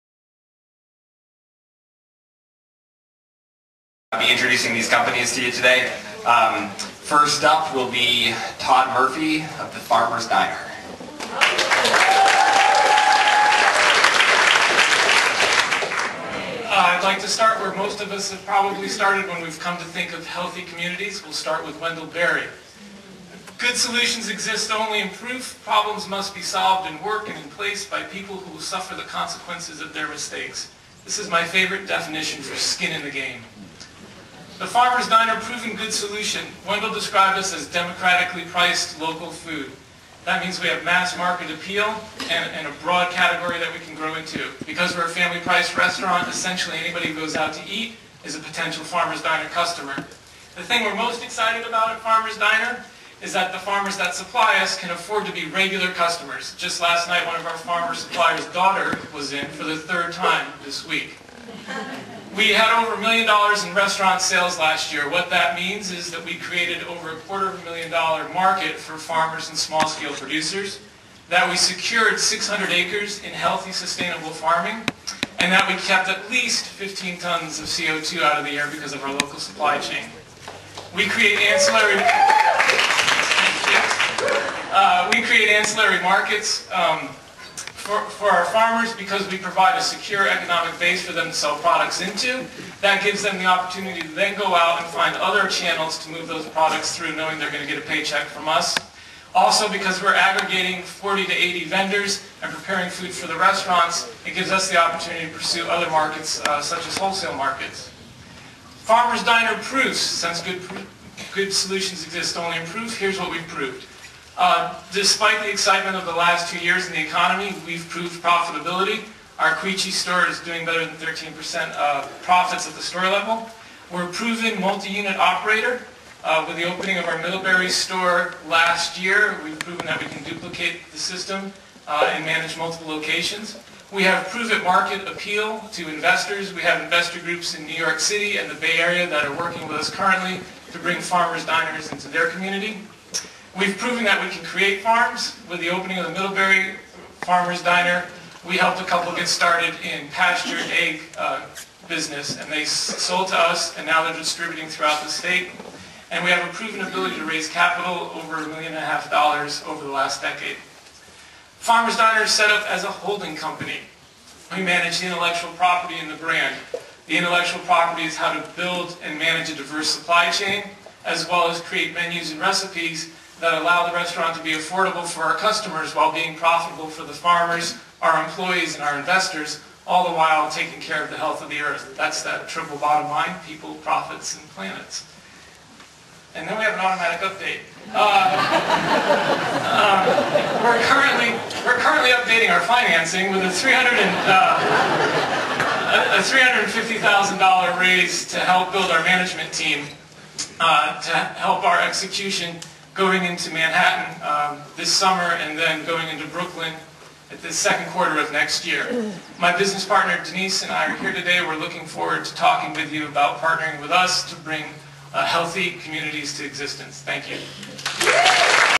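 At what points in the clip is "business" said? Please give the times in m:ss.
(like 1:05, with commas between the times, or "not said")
2:31, 3:29.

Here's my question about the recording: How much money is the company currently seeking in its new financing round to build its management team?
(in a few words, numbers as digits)
$350,000.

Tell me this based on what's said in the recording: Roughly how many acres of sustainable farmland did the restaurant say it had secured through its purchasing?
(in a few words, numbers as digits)
600.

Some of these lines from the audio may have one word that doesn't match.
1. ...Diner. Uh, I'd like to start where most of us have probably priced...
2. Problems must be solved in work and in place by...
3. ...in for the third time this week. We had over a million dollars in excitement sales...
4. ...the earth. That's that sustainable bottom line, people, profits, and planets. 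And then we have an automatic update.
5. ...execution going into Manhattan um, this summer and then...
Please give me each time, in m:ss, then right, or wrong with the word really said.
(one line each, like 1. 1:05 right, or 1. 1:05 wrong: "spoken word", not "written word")
1. 0:10 wrong: "started", not "priced"
2. 0:25 right
3. 0:59 wrong: "restaurant", not "excitement"
4. 3:01 wrong: "triple", not "sustainable"
5. 3:21 right.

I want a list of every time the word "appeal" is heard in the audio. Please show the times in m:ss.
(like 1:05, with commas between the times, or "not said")
0:41, 2:15.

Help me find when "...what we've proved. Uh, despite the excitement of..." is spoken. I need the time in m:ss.
1:53.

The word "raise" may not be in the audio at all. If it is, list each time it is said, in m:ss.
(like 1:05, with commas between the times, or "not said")
2:37, 3:17.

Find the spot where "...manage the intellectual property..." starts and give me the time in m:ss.
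2:44.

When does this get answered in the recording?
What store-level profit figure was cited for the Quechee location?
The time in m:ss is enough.
2:00.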